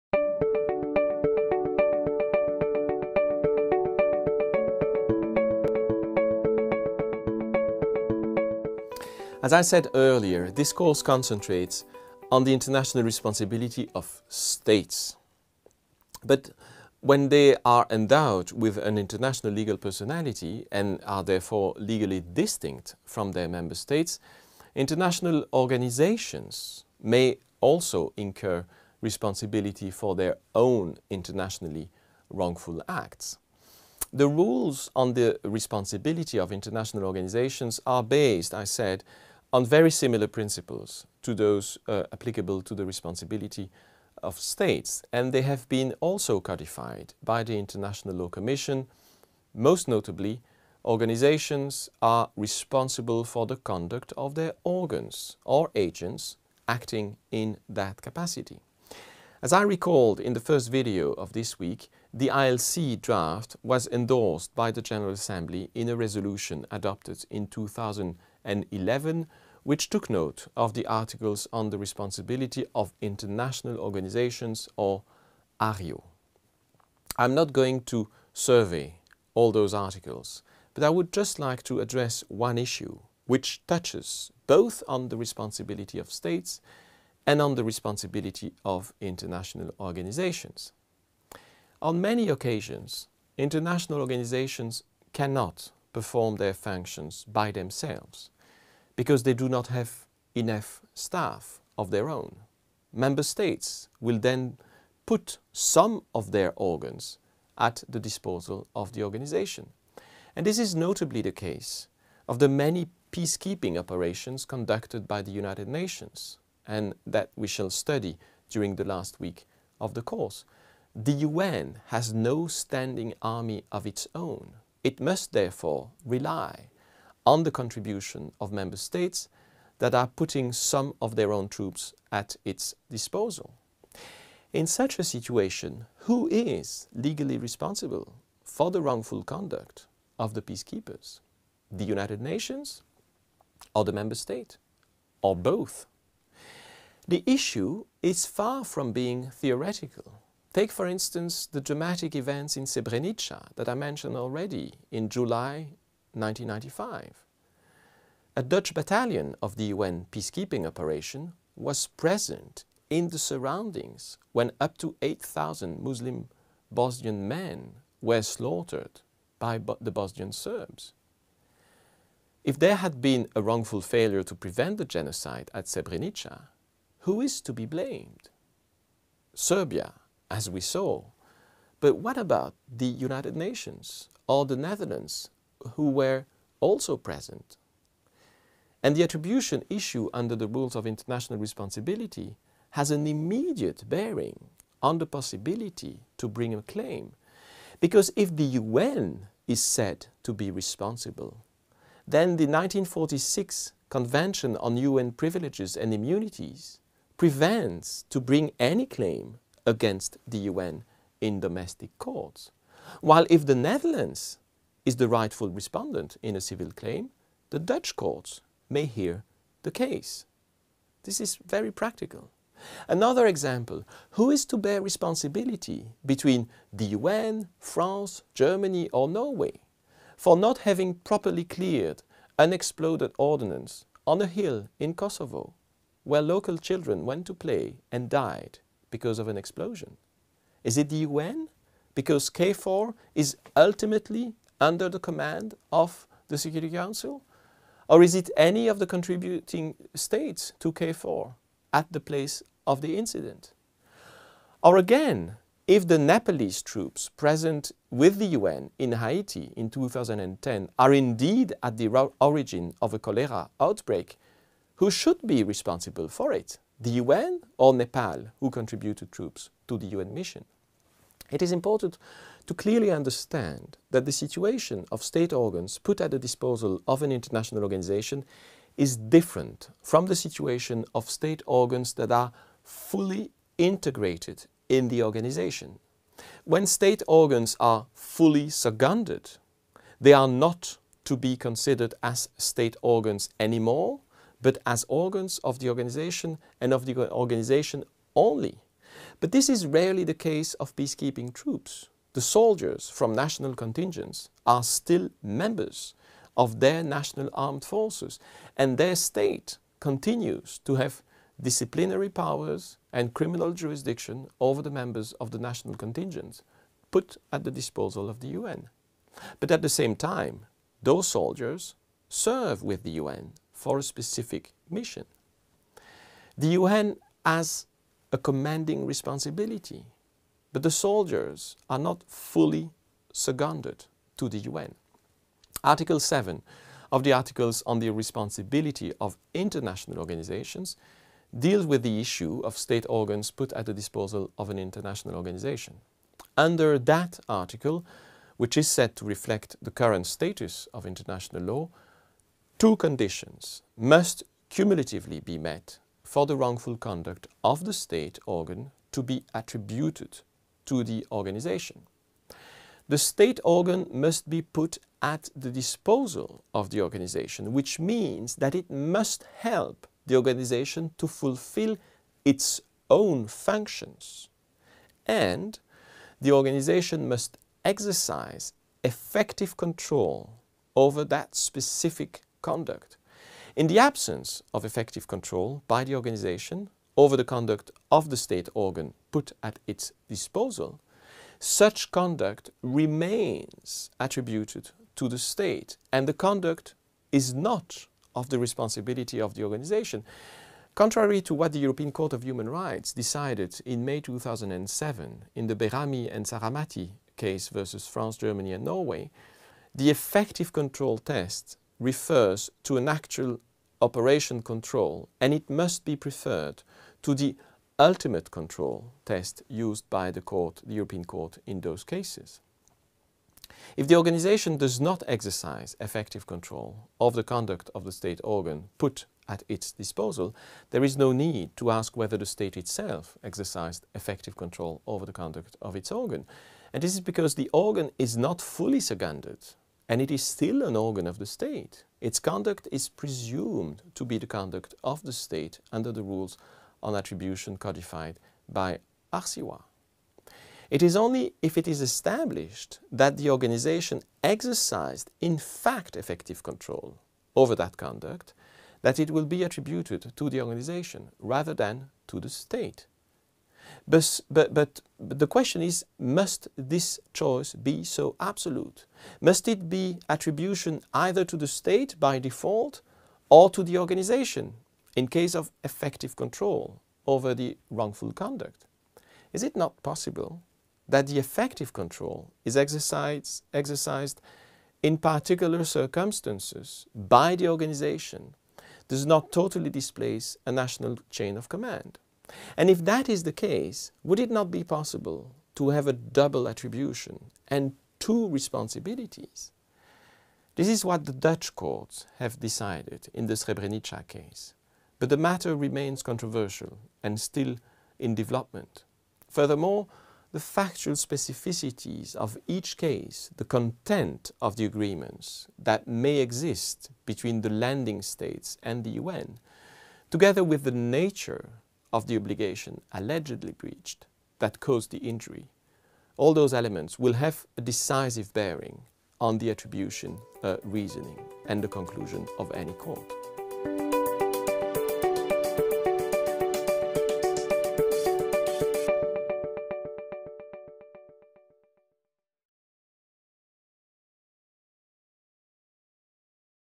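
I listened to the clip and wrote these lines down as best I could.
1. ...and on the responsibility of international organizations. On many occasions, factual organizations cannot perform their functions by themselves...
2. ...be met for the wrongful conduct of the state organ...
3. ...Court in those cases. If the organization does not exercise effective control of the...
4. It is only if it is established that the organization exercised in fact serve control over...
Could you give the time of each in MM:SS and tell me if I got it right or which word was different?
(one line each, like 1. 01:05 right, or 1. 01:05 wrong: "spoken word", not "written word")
1. 01:27 wrong: "international", not "factual"
2. 05:55 right
3. 07:01 right
4. 07:30 wrong: "effective", not "serve".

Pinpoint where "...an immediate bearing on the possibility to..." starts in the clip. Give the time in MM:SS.
03:12.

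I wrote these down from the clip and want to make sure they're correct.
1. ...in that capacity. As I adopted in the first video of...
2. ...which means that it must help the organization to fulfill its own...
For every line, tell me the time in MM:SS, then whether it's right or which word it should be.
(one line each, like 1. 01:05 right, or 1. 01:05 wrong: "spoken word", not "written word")
1. 00:57 wrong: "recalled", not "adopted"
2. 06:07 right.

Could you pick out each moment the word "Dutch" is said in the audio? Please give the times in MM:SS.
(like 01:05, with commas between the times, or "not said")
02:38, 03:37, 08:21.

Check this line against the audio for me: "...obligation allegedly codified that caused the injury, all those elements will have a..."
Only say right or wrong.
wrong.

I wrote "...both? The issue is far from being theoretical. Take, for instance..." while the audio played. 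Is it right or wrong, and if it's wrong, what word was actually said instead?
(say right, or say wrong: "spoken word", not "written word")
right.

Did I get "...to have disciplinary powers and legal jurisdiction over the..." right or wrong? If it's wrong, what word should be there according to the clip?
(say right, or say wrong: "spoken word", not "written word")
wrong: "criminal", not "legal".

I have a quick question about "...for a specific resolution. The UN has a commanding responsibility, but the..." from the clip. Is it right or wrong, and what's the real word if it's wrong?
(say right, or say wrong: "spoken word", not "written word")
wrong: "mission", not "resolution".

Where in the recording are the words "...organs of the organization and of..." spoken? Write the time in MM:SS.
04:54.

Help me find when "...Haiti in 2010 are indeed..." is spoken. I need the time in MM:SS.
04:18.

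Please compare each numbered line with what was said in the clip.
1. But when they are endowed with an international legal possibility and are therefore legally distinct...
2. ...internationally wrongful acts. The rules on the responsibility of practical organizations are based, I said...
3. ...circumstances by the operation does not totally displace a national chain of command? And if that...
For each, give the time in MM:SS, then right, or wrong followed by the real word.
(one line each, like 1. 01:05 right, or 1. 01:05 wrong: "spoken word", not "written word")
1. 00:16 wrong: "personality", not "possibility"
2. 00:31 wrong: "international", not "practical"
3. 08:05 wrong: "organization", not "operation".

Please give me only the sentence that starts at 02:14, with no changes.
In such a situation, who is legally responsible for the wrongful conduct of the peacekeepers?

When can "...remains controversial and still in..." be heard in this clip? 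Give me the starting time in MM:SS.
08:25.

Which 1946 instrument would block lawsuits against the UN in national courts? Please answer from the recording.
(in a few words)
Convention on UN Privileges and Immunities.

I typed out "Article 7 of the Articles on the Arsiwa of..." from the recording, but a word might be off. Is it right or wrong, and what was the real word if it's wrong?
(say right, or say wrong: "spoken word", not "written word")
wrong: "Responsibility", not "Arsiwa".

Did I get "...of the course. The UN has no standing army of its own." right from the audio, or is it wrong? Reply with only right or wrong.
right.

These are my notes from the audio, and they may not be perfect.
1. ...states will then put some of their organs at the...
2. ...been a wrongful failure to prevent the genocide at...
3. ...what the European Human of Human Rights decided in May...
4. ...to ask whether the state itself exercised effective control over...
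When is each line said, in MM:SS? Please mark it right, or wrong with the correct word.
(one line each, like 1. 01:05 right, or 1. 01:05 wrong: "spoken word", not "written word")
1. 01:43 right
2. 02:52 right
3. 06:41 wrong: "Court", not "Human"
4. 07:11 right.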